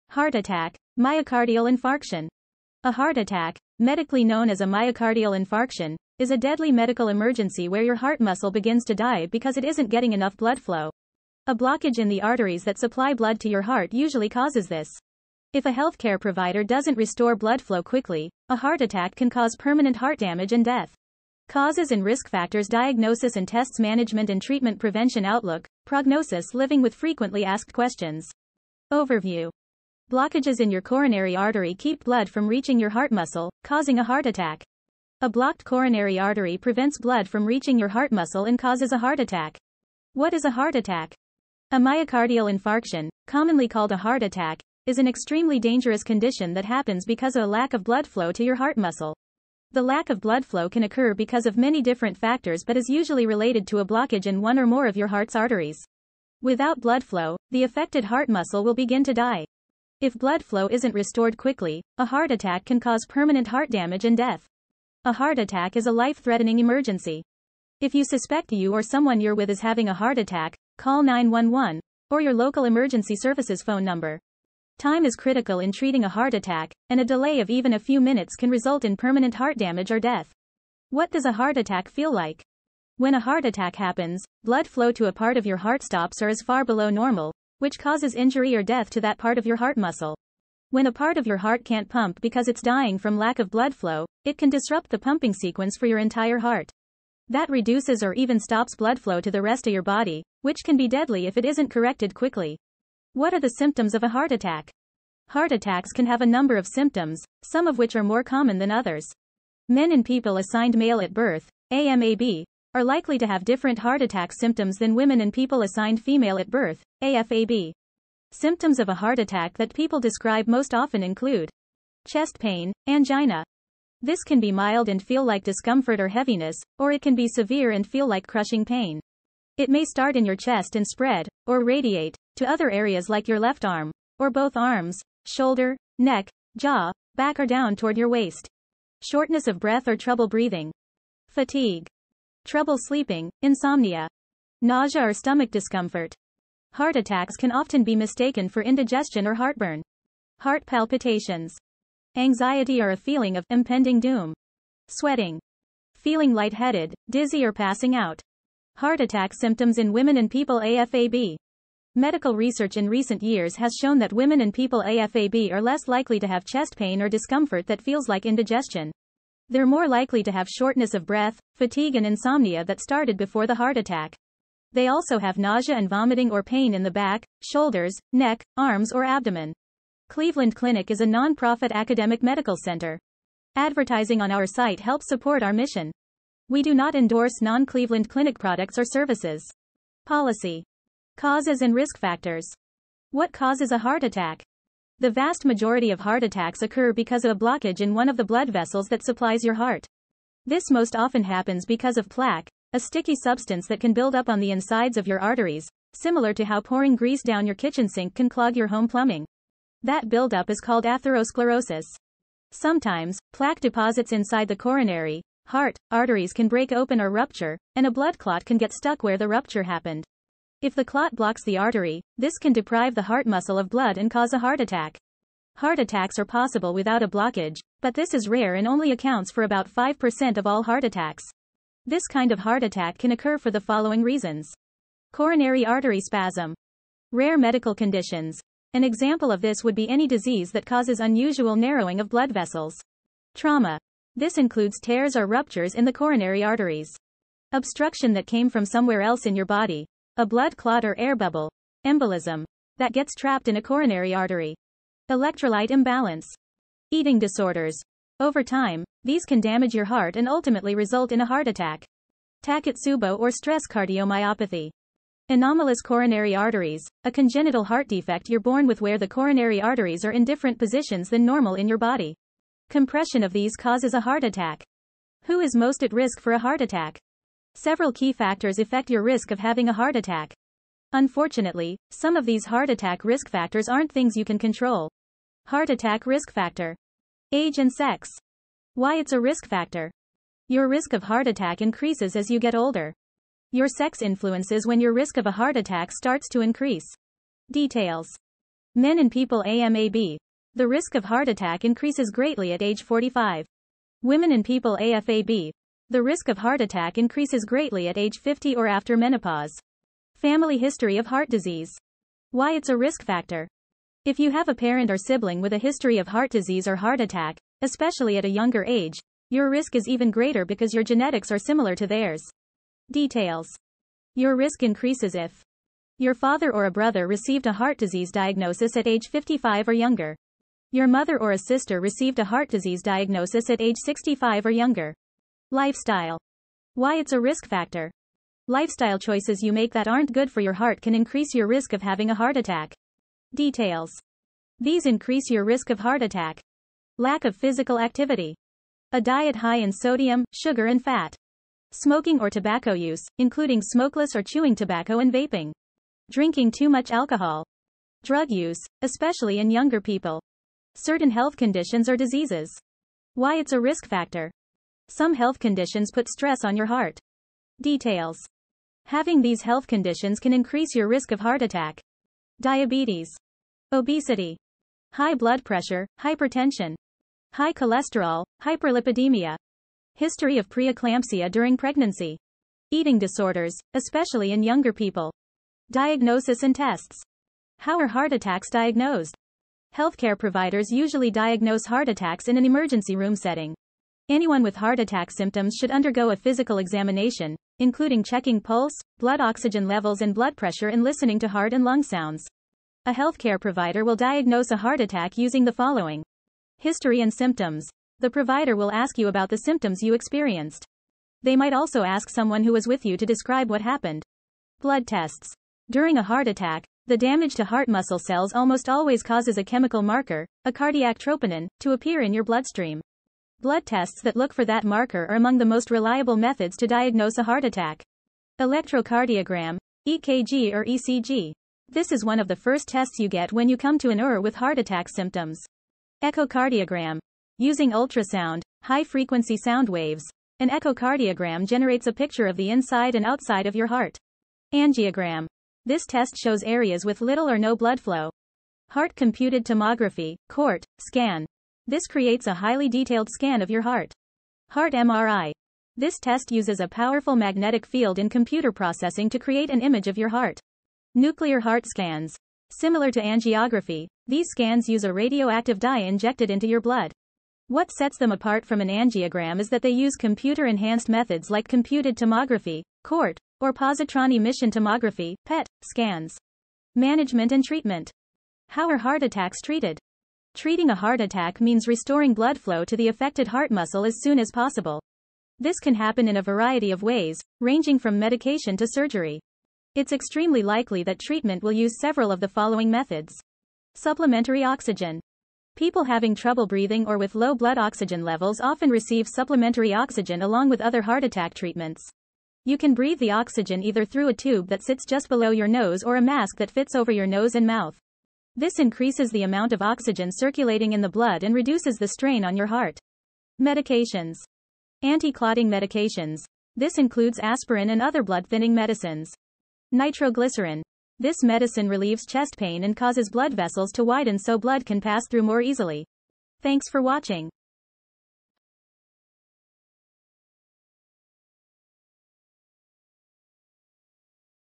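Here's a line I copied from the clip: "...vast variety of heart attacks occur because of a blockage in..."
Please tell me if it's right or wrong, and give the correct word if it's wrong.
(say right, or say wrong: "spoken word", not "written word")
wrong: "majority", not "variety".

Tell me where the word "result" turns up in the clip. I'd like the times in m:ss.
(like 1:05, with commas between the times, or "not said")
1:18, 4:20.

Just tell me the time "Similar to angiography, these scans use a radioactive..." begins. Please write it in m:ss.
7:42.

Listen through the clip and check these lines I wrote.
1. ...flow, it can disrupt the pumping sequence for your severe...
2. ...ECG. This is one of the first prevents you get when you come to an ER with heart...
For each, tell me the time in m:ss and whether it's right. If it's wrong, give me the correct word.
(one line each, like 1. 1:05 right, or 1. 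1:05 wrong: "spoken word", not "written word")
1. 1:33 wrong: "entire", not "severe"
2. 7:10 wrong: "tests", not "prevents".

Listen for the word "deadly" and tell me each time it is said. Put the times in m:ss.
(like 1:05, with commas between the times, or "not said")
0:06, 1:40.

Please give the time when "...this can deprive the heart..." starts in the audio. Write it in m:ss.
3:42.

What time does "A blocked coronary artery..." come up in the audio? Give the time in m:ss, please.
0:35.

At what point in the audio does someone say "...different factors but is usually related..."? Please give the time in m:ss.
0:51.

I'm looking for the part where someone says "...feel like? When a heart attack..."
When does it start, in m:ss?
1:21.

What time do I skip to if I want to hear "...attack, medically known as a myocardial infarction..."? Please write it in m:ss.
0:03.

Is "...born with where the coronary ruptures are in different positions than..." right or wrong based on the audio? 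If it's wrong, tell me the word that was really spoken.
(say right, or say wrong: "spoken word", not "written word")
wrong: "arteries", not "ruptures".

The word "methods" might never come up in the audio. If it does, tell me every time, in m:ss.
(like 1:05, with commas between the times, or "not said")
7:06, 7:50, 8:12.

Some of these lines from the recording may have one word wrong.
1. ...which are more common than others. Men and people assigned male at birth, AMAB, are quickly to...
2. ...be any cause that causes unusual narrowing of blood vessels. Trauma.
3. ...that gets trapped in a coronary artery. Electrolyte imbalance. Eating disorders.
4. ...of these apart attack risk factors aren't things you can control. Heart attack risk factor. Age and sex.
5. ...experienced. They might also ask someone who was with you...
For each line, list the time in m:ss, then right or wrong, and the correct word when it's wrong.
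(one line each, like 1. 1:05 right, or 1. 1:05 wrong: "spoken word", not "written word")
1. 1:47 wrong: "likely", not "quickly"
2. 3:59 wrong: "disease", not "cause"
3. 4:12 right
4. 4:42 wrong: "heart", not "apart"
5. 6:49 right.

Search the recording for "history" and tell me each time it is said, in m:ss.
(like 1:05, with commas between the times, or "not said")
5:10, 5:15, 6:19, 6:46.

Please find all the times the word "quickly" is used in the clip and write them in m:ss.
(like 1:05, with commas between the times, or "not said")
0:17, 1:01, 1:42.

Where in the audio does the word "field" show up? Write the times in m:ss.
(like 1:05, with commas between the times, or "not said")
7:37.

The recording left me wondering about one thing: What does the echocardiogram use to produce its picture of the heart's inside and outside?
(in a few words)
high-frequency sound waves.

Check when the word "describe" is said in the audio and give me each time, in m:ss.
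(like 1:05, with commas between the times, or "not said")
1:59, 6:53.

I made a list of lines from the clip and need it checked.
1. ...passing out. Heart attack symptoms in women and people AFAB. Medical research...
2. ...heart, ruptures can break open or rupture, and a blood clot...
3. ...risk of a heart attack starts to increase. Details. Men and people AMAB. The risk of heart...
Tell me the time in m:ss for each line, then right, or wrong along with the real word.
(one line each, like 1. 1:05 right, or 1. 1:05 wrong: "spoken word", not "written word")
1. 2:37 right
2. 3:35 wrong: "arteries", not "ruptures"
3. 4:54 right.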